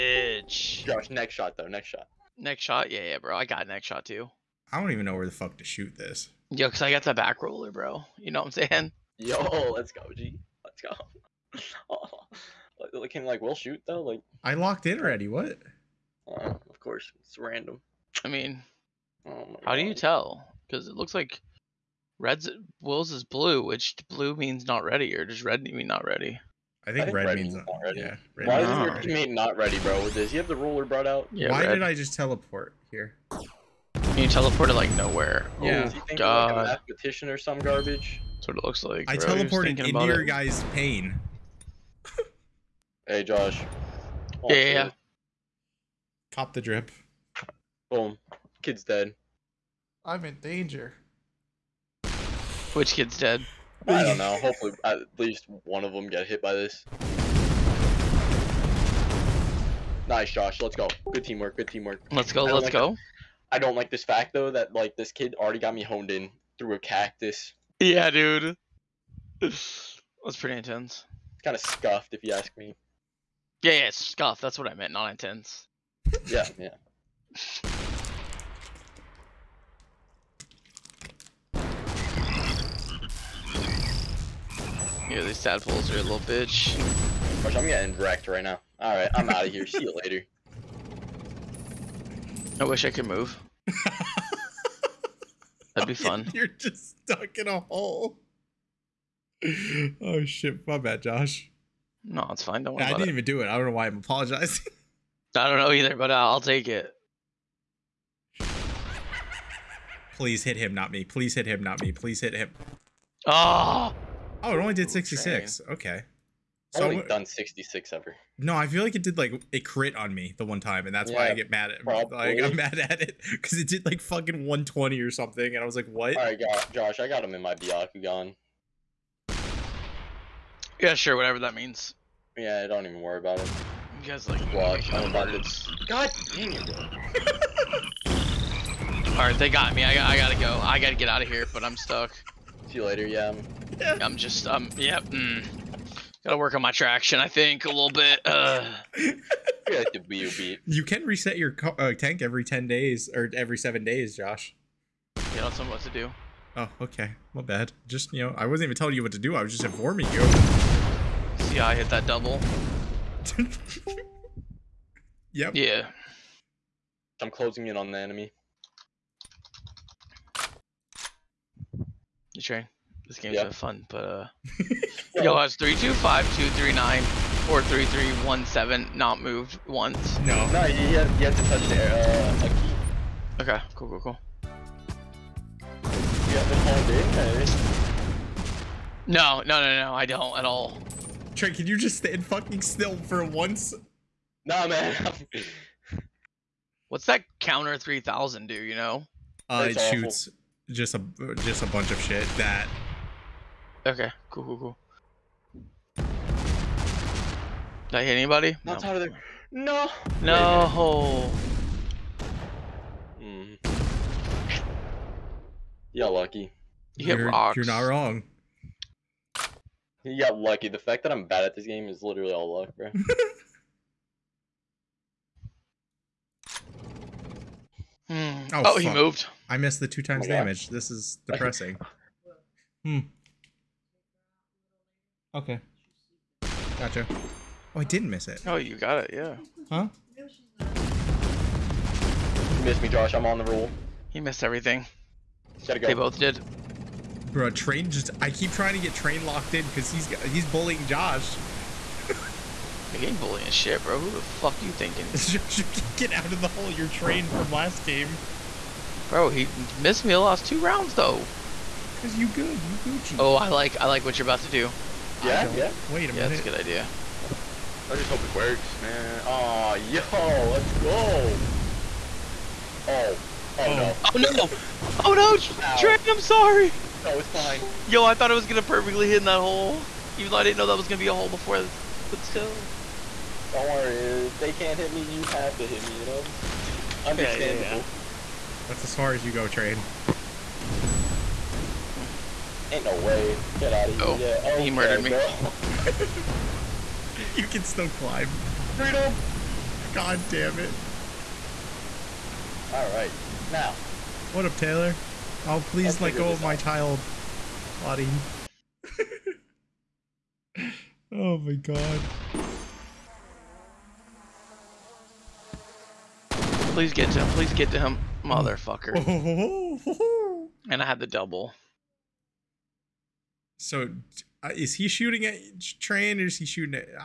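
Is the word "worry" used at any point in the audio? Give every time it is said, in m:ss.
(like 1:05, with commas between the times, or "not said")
1:42, 2:13, 4:43.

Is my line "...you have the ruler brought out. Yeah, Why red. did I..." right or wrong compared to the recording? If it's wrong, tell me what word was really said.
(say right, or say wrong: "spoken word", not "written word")
right.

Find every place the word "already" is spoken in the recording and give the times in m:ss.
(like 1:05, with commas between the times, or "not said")
0:14, 1:05.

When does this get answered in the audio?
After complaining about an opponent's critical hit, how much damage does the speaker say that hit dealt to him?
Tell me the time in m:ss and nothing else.
2:04.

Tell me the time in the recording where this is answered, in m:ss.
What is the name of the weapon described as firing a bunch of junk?
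3:17.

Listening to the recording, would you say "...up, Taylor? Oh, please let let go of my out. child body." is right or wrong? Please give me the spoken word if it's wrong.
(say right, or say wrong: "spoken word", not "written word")
right.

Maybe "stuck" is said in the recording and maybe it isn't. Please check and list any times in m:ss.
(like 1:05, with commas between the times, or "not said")
1:37, 2:21.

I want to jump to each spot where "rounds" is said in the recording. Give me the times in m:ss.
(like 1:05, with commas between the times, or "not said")
4:20.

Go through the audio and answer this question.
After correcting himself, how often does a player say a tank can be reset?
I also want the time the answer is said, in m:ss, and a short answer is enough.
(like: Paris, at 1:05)
Every 7 days, at 2:33.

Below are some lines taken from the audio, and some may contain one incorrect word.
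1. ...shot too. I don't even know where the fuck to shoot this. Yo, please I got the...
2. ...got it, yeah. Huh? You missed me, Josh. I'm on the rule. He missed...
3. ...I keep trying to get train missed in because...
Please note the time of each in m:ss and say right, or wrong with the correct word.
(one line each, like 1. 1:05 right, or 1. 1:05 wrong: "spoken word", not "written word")
1. 0:03 wrong: "cause", not "please"
2. 3:58 right
3. 4:08 wrong: "locked", not "missed".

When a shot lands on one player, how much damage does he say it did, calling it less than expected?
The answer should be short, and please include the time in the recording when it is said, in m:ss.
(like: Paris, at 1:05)
66, at 1:54.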